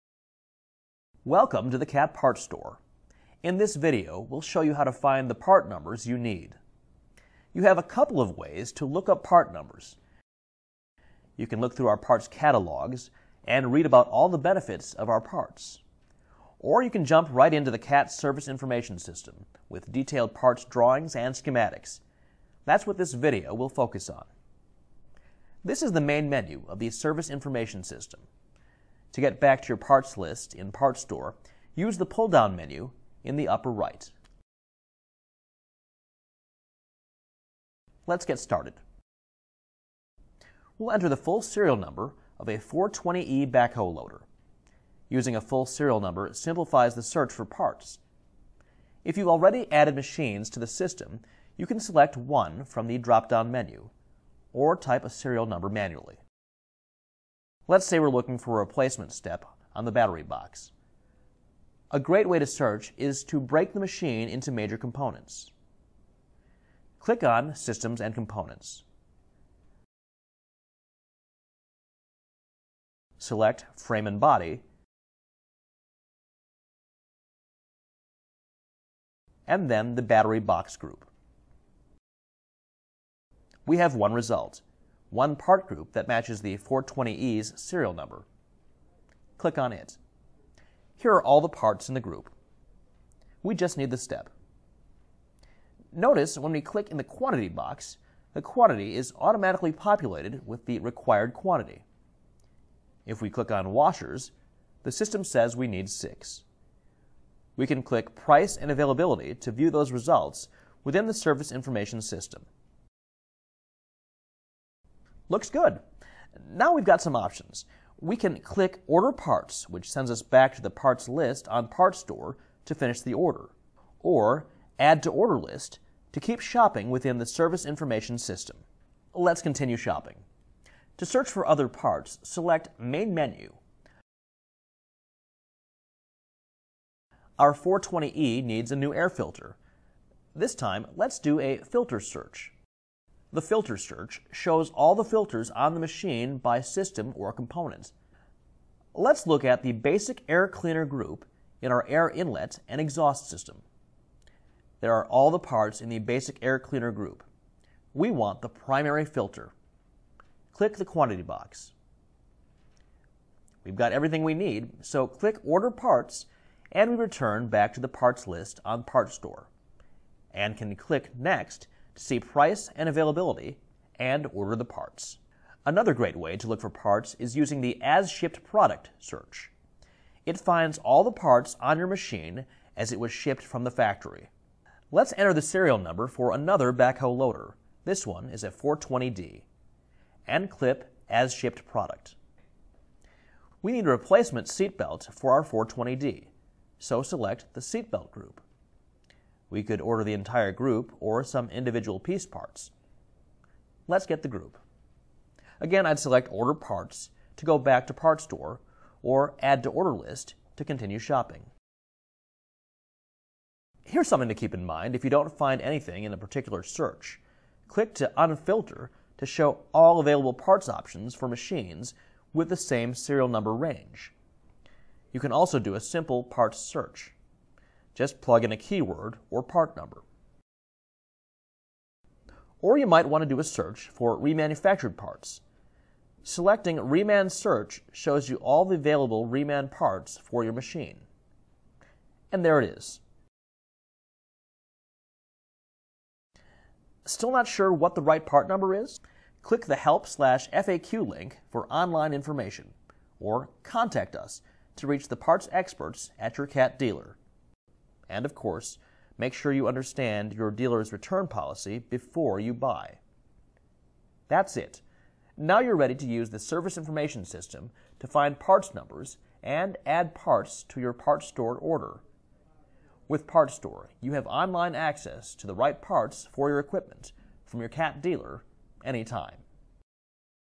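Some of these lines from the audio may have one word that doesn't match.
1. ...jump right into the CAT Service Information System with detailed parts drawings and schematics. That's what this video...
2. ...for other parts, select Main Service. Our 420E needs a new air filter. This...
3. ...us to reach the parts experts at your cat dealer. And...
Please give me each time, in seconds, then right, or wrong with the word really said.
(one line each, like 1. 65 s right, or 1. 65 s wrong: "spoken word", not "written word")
1. 17 s right
2. 131 s wrong: "Menu", not "Service"
3. 254 s right.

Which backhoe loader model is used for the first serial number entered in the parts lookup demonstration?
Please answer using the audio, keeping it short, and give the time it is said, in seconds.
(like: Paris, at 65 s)
420E, at 42 s.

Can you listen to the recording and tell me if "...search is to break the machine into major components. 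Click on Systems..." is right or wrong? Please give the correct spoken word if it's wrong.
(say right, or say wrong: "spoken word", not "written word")
right.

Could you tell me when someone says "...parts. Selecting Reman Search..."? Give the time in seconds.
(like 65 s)
234 s.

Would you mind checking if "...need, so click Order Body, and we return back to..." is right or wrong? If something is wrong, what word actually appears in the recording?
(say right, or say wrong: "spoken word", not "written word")
wrong: "Parts", not "Body".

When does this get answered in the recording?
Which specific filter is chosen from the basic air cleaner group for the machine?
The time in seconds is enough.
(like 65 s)
158 s.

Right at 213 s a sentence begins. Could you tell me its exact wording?
Here's something to keep in mind if you don't find anything in a particular search.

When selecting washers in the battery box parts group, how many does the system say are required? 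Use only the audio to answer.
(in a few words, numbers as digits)
6.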